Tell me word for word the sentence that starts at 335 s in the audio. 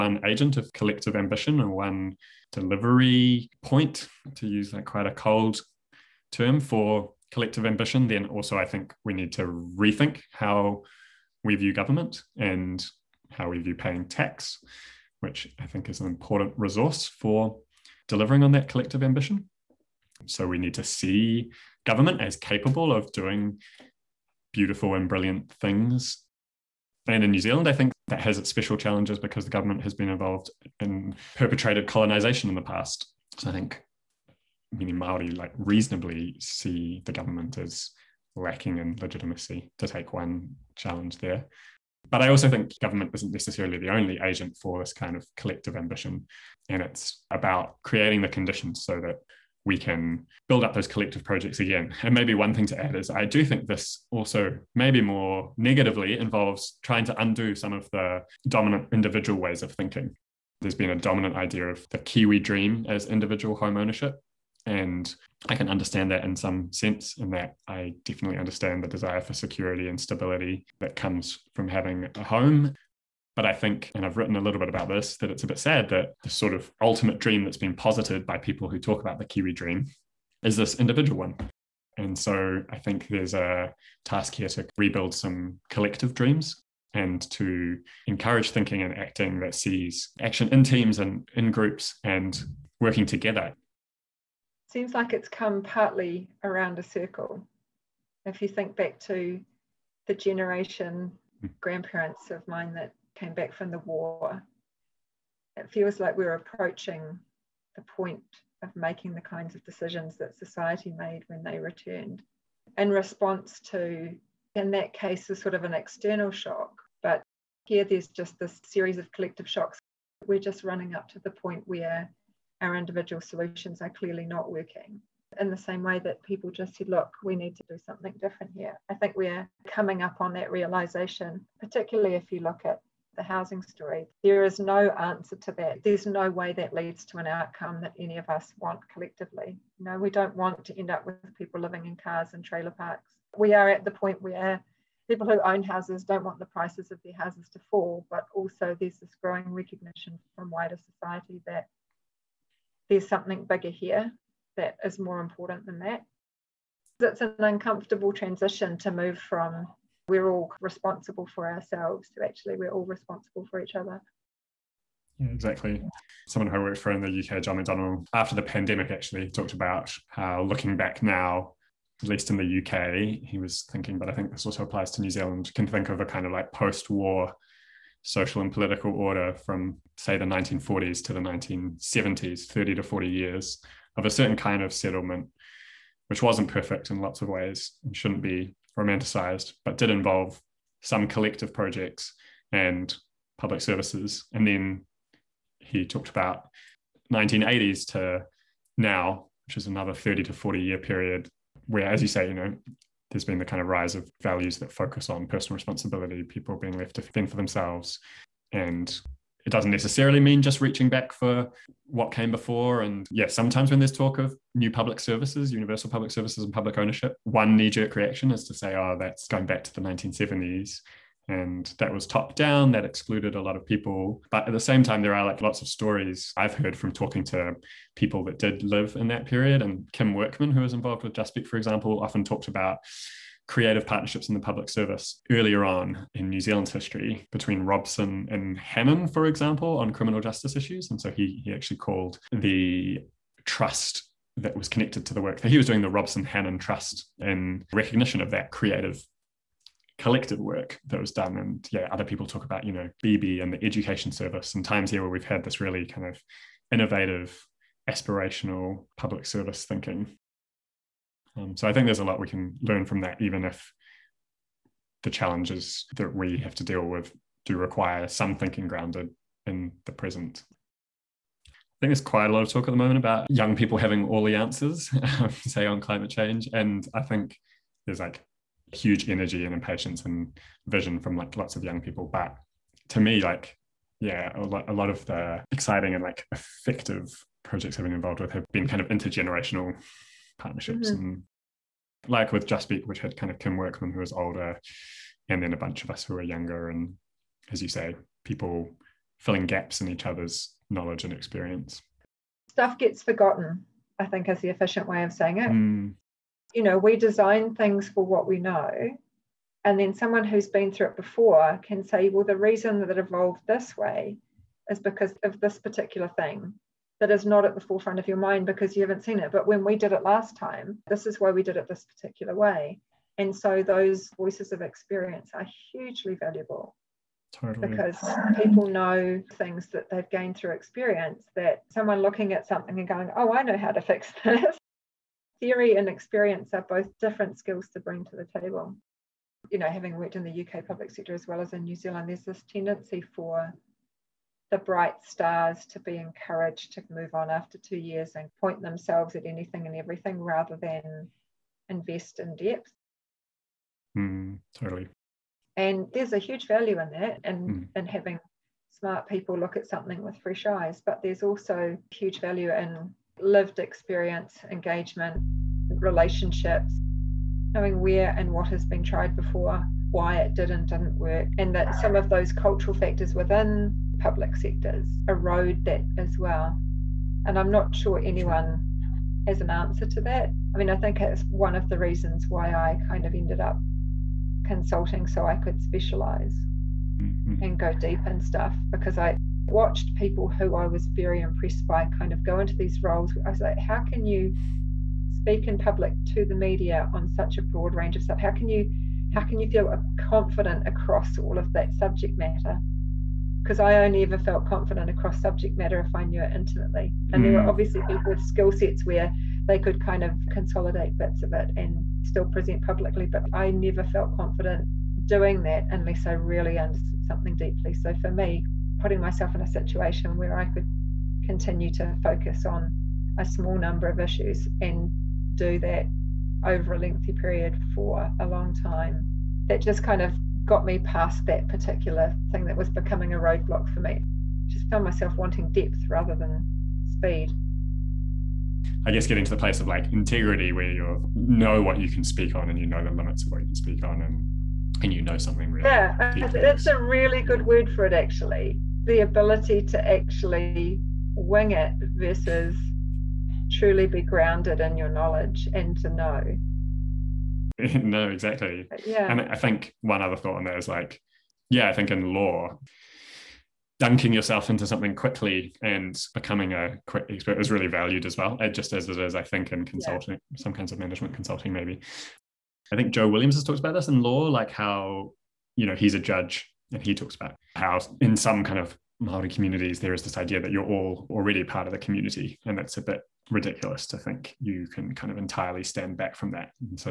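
Theory and experience are both different skills to bring to the table.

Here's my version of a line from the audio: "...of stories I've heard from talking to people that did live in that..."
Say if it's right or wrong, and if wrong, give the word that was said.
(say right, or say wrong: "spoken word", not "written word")
right.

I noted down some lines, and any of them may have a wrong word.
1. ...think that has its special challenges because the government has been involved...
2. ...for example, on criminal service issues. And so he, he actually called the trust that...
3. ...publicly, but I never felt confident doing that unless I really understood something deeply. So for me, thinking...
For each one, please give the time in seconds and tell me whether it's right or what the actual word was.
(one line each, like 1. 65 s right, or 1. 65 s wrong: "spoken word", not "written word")
1. 27 s right
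2. 239 s wrong: "justice", not "service"
3. 412 s wrong: "putting", not "thinking".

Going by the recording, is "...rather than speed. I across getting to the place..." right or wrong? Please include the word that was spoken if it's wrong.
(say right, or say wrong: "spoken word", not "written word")
wrong: "guess", not "across".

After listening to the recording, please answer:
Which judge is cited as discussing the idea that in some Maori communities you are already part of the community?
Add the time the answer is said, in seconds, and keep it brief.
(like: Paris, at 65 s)
Joe Williams, at 472 s.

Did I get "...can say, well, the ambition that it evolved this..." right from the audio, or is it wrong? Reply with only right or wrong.
wrong.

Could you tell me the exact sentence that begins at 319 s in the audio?
But when we did it last time, this is why we did it this particular way.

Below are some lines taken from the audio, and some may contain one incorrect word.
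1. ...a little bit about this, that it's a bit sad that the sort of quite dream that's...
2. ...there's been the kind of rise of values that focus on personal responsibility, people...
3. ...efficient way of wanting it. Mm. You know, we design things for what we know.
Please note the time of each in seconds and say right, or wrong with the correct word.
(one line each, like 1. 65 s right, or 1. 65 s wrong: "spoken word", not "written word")
1. 74 s wrong: "ultimate", not "quite"
2. 203 s right
3. 304 s wrong: "saying", not "wanting".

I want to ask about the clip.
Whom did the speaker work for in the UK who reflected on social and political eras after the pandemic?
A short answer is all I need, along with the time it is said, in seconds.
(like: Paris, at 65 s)
John McDonnell, at 167 s.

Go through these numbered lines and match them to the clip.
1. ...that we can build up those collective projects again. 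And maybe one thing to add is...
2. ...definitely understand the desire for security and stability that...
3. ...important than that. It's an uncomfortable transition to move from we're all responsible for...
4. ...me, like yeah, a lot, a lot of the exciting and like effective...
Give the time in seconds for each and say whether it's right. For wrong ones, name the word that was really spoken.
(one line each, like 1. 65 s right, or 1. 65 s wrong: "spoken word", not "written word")
1. 48 s right
2. 68 s right
3. 155 s right
4. 282 s right.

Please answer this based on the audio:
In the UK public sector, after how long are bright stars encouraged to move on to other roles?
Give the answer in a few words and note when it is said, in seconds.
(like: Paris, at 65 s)
2 years, at 347 s.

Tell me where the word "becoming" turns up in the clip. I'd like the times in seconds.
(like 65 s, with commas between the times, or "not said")
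432 s, 466 s.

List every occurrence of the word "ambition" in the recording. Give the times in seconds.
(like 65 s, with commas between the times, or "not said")
1 s, 7 s, 19 s, 45 s.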